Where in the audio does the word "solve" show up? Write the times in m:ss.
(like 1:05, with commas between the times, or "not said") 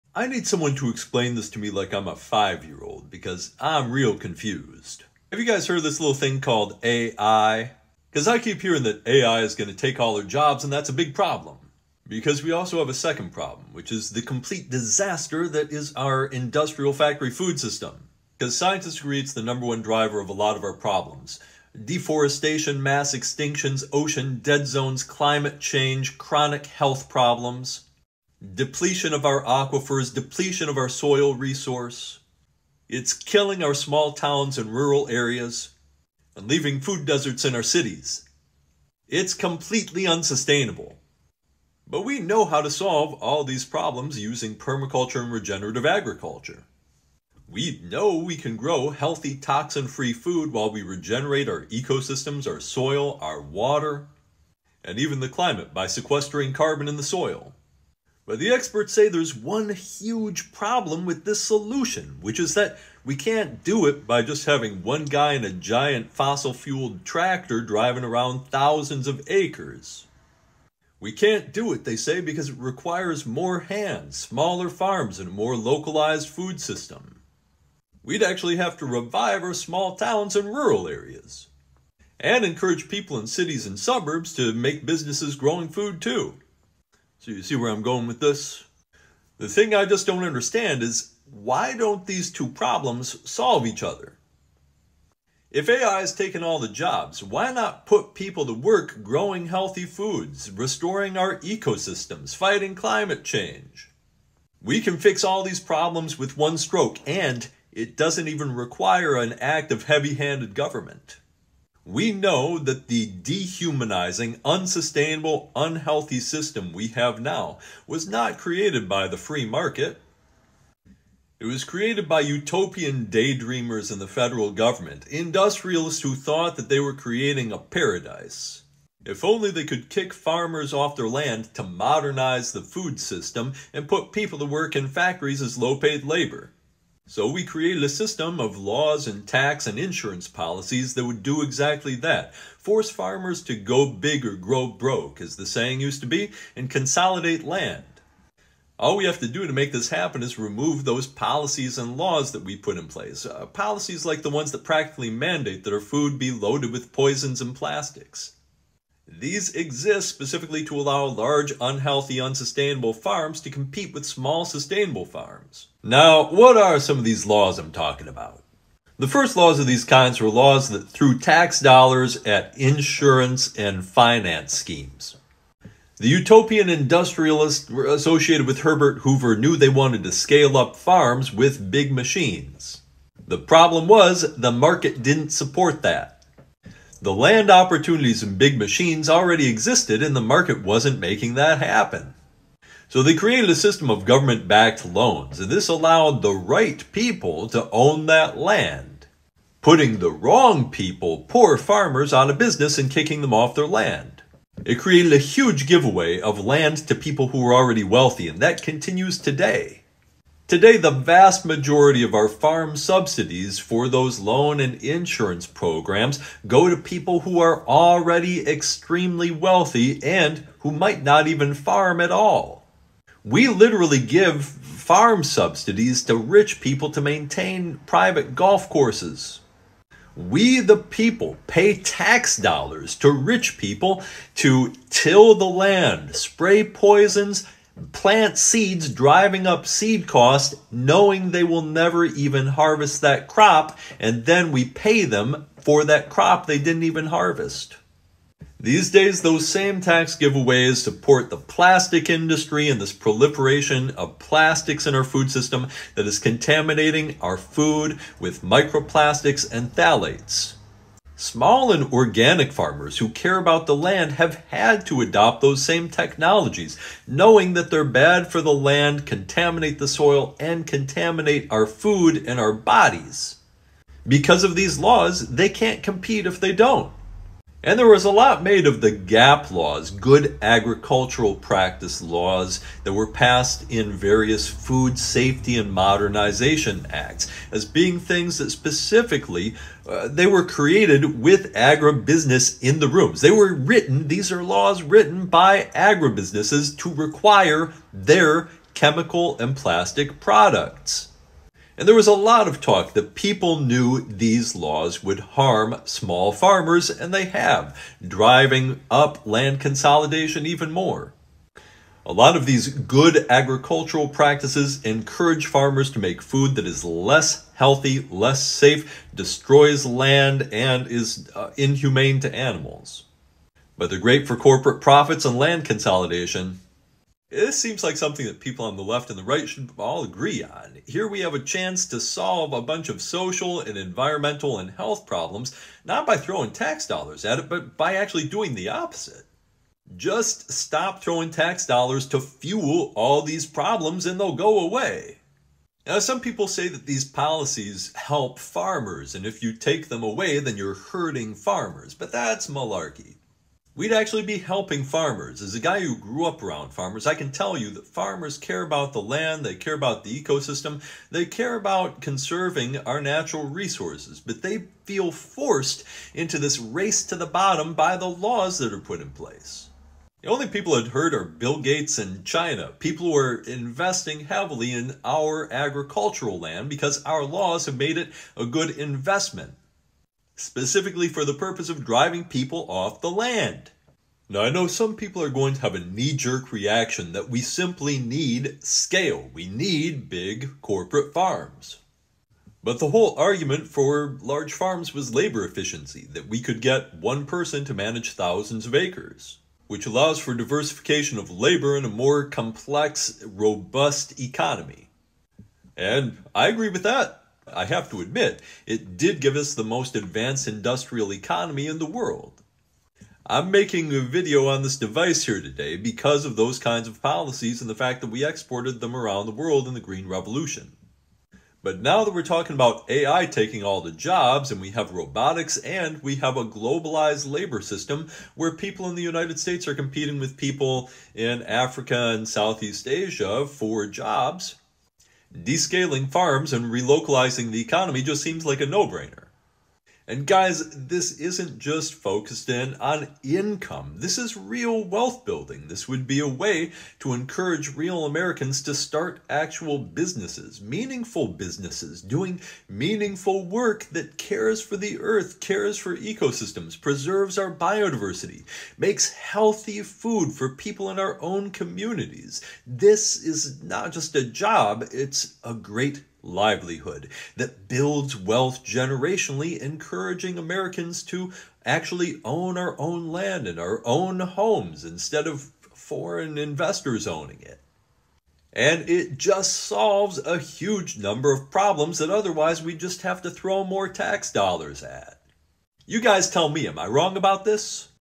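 0:42, 1:33, 5:32, 7:59.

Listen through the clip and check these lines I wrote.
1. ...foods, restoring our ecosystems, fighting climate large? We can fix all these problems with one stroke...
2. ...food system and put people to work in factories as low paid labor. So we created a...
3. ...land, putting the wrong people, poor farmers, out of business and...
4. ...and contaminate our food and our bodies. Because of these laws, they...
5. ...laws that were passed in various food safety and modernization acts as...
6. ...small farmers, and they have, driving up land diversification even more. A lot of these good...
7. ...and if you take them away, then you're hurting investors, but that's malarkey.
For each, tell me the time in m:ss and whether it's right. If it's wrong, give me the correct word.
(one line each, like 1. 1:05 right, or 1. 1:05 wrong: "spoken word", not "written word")
1. 1:39 wrong: "change", not "large"
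2. 2:12 right
3. 3:18 right
4. 4:30 right
5. 4:42 right
6. 5:05 wrong: "consolidation", not "diversification"
7. 5:49 wrong: "farmers", not "investors".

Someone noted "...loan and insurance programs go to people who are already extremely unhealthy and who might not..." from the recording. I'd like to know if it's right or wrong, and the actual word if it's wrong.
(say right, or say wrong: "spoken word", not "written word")
wrong: "wealthy", not "unhealthy".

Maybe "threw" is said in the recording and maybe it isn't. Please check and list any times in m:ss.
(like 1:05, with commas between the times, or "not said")
2:50.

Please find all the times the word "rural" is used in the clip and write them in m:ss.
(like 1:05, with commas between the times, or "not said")
0:34, 1:20.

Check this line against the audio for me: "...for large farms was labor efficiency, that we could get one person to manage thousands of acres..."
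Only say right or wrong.
right.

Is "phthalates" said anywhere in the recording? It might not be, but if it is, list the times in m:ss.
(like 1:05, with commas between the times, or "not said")
4:19.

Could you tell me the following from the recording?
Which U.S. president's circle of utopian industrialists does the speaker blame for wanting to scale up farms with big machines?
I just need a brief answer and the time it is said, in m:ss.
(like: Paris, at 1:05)
Herbert Hoover, at 2:58.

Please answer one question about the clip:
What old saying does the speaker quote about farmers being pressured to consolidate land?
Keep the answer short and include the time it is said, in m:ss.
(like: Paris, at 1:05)
go big or grow broke, at 2:23.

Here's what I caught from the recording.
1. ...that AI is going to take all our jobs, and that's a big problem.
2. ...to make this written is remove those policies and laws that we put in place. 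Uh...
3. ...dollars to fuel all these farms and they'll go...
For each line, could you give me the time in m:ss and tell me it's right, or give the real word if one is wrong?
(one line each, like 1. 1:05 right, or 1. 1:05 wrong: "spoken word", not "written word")
1. 0:08 right
2. 2:29 wrong: "happen", not "written"
3. 5:41 wrong: "problems", not "farms".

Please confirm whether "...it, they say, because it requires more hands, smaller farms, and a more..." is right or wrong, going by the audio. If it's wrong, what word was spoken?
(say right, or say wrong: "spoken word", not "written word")
right.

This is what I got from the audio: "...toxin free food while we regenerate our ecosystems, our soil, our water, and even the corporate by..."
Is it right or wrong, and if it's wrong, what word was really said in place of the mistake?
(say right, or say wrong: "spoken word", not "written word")
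wrong: "climate", not "corporate".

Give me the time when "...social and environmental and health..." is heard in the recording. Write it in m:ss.
5:33.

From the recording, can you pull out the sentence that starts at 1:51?
We know that the dehumanizing, unsustainable, unhealthy system we have now was not created by the free market.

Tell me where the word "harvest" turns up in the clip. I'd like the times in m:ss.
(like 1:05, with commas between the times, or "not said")
4:02, 4:07.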